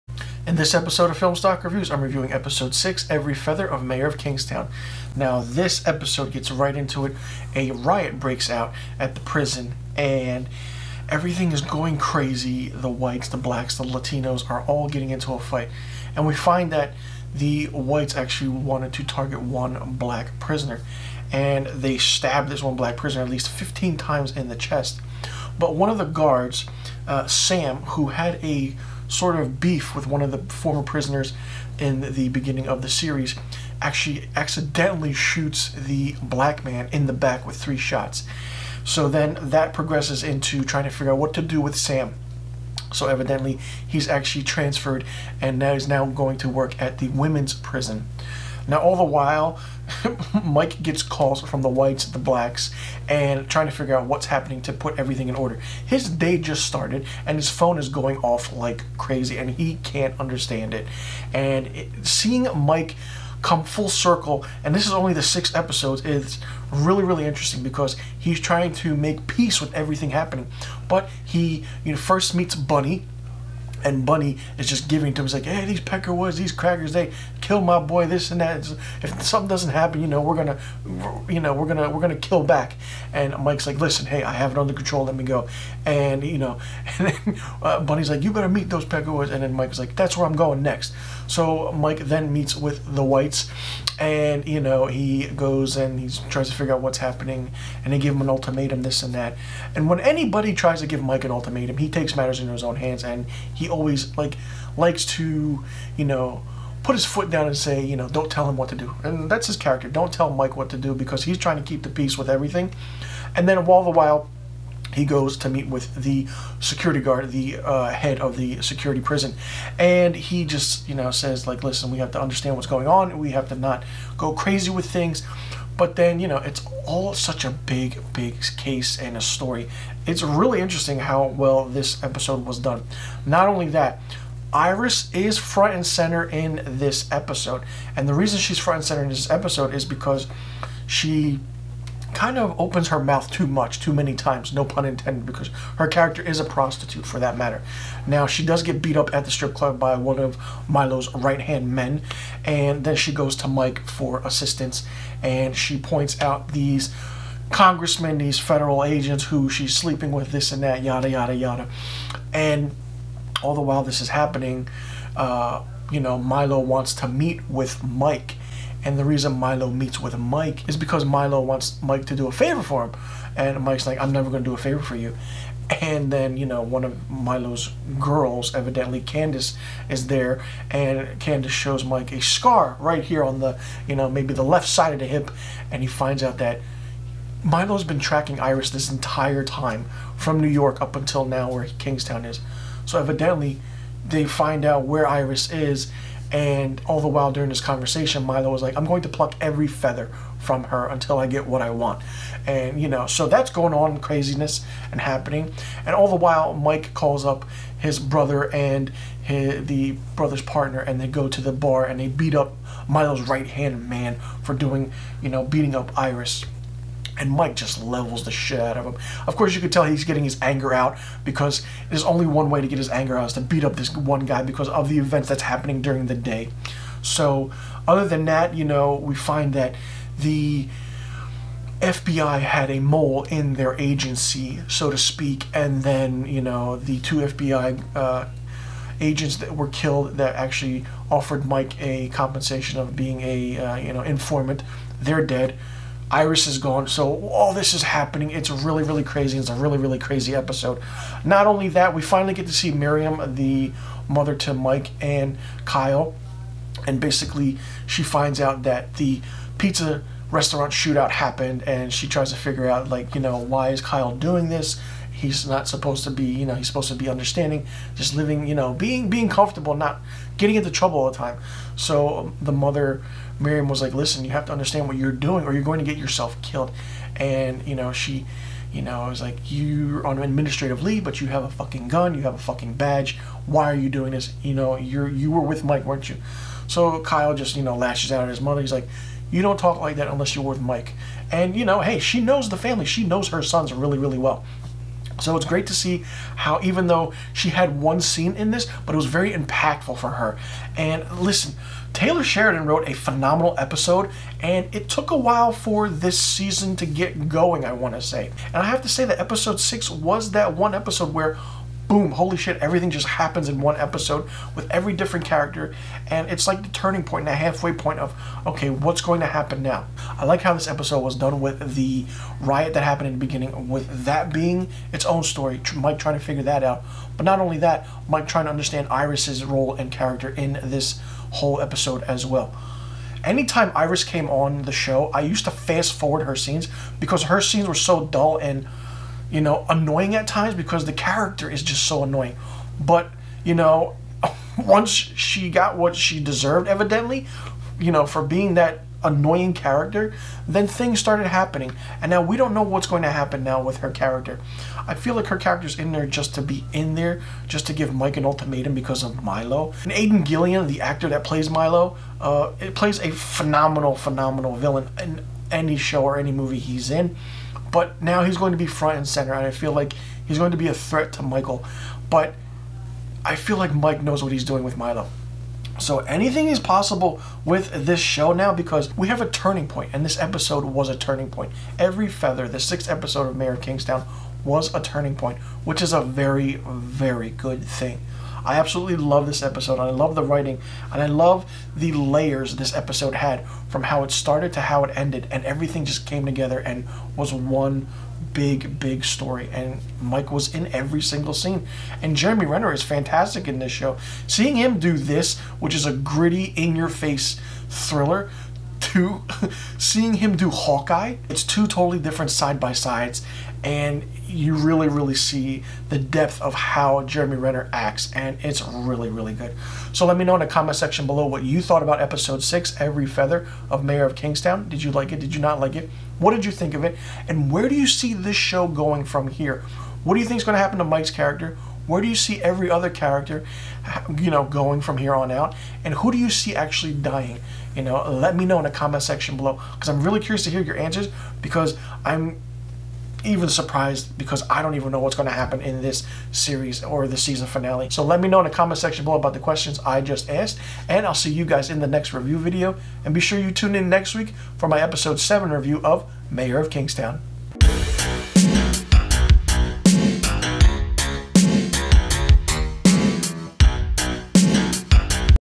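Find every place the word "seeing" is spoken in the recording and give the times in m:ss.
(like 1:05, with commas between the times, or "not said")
1:02, 6:44, 6:49.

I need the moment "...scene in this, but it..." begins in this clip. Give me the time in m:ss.
4:58.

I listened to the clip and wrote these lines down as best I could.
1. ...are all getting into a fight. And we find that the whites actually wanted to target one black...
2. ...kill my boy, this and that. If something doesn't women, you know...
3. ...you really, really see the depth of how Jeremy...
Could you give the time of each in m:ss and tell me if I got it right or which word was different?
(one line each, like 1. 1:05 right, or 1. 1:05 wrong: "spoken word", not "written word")
1. 0:14 right
2. 1:17 wrong: "happen", not "women"
3. 6:54 right.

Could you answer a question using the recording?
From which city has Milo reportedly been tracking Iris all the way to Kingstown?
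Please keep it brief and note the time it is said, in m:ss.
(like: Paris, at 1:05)
New York, at 3:10.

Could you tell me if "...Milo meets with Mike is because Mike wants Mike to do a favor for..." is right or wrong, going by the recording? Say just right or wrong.
wrong.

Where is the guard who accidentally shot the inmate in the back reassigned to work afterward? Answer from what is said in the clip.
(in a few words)
the women's prison.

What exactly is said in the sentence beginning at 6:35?
And everything just came together and was one big, big story.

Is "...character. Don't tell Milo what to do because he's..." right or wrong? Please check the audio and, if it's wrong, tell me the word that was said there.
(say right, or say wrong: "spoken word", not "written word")
wrong: "Mike", not "Milo".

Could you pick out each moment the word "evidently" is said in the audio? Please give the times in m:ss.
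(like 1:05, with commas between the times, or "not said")
0:43, 2:58, 3:12, 5:46.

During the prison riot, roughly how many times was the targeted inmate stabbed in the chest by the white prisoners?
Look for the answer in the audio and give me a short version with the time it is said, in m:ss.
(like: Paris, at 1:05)
15, at 0:23.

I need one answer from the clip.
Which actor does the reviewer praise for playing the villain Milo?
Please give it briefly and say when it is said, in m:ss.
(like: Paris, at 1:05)
Aidan Gillen, at 5:59.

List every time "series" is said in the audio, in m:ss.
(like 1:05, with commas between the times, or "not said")
0:32, 7:26.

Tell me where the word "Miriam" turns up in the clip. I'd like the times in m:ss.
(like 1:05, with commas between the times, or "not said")
4:12, 4:33.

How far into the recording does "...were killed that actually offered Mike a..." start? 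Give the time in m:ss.
3:59.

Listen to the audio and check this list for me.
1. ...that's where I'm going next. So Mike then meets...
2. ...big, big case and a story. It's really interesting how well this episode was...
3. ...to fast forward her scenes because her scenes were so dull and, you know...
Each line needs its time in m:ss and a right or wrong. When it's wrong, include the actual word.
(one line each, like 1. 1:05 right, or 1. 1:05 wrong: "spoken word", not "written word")
1. 1:29 right
2. 2:07 right
3. 5:35 right.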